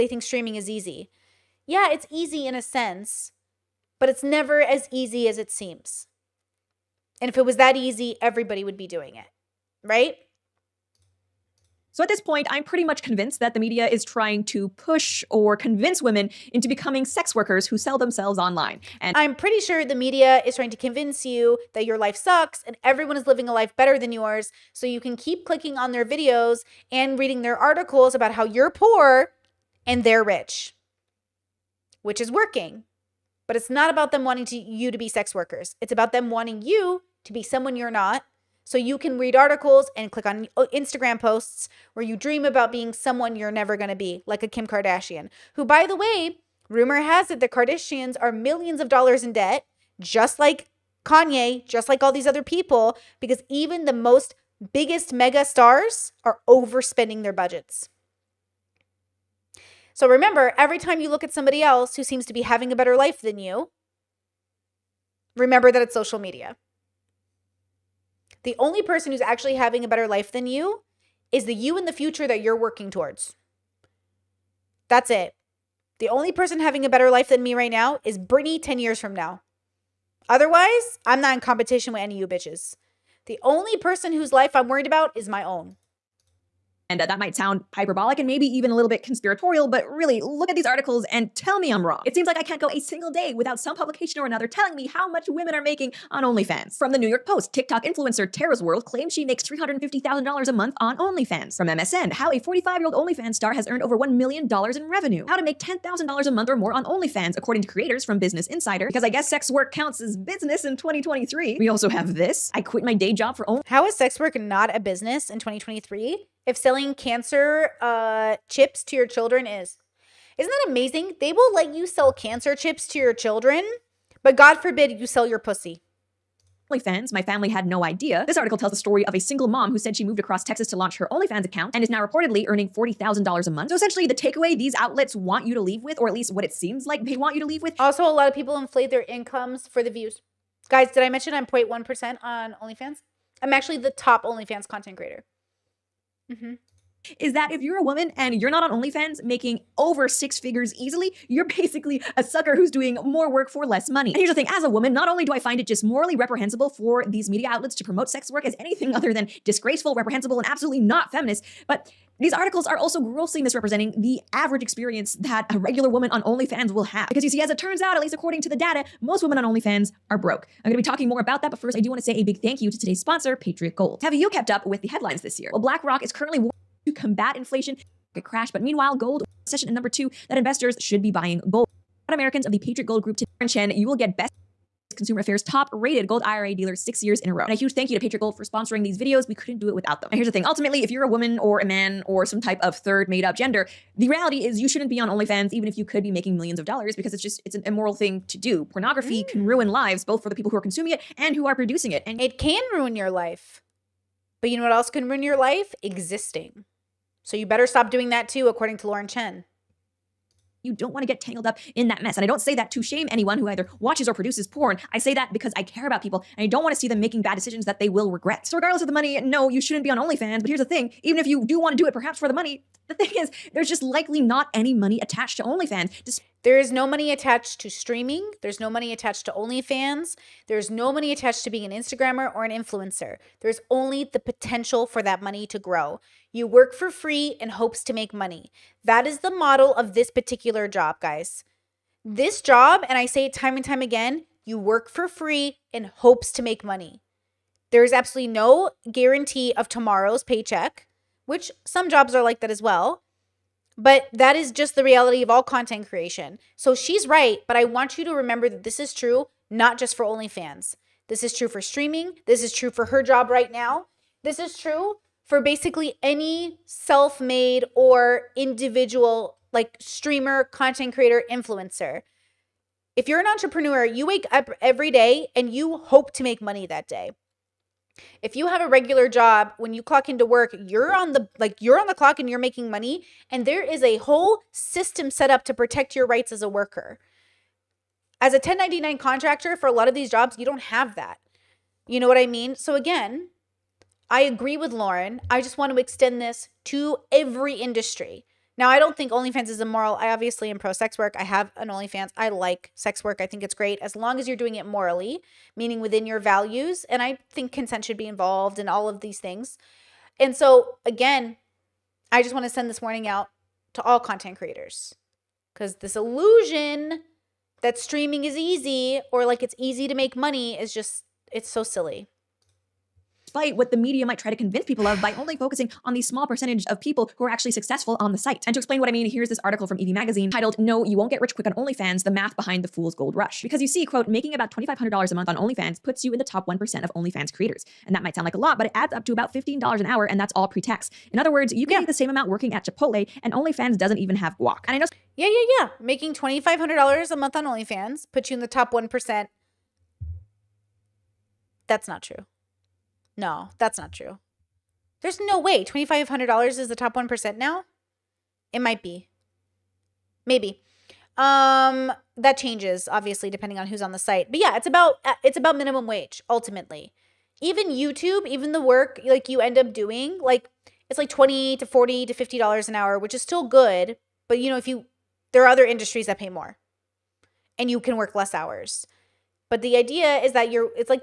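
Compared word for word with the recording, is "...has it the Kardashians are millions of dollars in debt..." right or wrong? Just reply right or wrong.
right.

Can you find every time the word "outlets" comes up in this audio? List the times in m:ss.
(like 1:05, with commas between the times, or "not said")
2:14, 2:37.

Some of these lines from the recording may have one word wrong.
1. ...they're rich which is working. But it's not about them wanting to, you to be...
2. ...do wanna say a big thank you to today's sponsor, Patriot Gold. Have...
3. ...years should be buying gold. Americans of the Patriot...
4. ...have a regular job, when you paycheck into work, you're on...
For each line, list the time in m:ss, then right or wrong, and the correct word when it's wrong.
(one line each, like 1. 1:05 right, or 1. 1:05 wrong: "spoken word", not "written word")
1. 0:30 right
2. 2:51 right
3. 3:00 wrong: "investors", not "years"
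4. 4:38 wrong: "clock", not "paycheck".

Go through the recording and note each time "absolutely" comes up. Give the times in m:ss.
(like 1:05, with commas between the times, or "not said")
2:40, 4:07.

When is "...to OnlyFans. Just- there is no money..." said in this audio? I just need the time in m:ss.
3:45.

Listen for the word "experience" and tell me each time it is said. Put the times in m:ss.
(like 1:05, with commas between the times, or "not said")
2:44.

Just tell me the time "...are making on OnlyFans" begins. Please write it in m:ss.
1:35.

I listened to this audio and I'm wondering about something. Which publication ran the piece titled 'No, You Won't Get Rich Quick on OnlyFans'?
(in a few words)
Evie Magazine.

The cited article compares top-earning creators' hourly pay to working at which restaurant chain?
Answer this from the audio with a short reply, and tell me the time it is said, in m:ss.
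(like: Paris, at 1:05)
Chipotle, at 5:42.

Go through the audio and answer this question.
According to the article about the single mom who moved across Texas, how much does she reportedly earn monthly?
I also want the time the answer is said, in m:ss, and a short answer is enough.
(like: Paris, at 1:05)
$40,000, at 2:12.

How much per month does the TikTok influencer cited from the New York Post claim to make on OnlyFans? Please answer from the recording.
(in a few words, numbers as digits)
$350,000.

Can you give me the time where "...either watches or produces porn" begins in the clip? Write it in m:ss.
3:33.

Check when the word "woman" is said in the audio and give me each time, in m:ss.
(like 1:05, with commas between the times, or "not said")
2:27, 2:34, 2:45, 3:11.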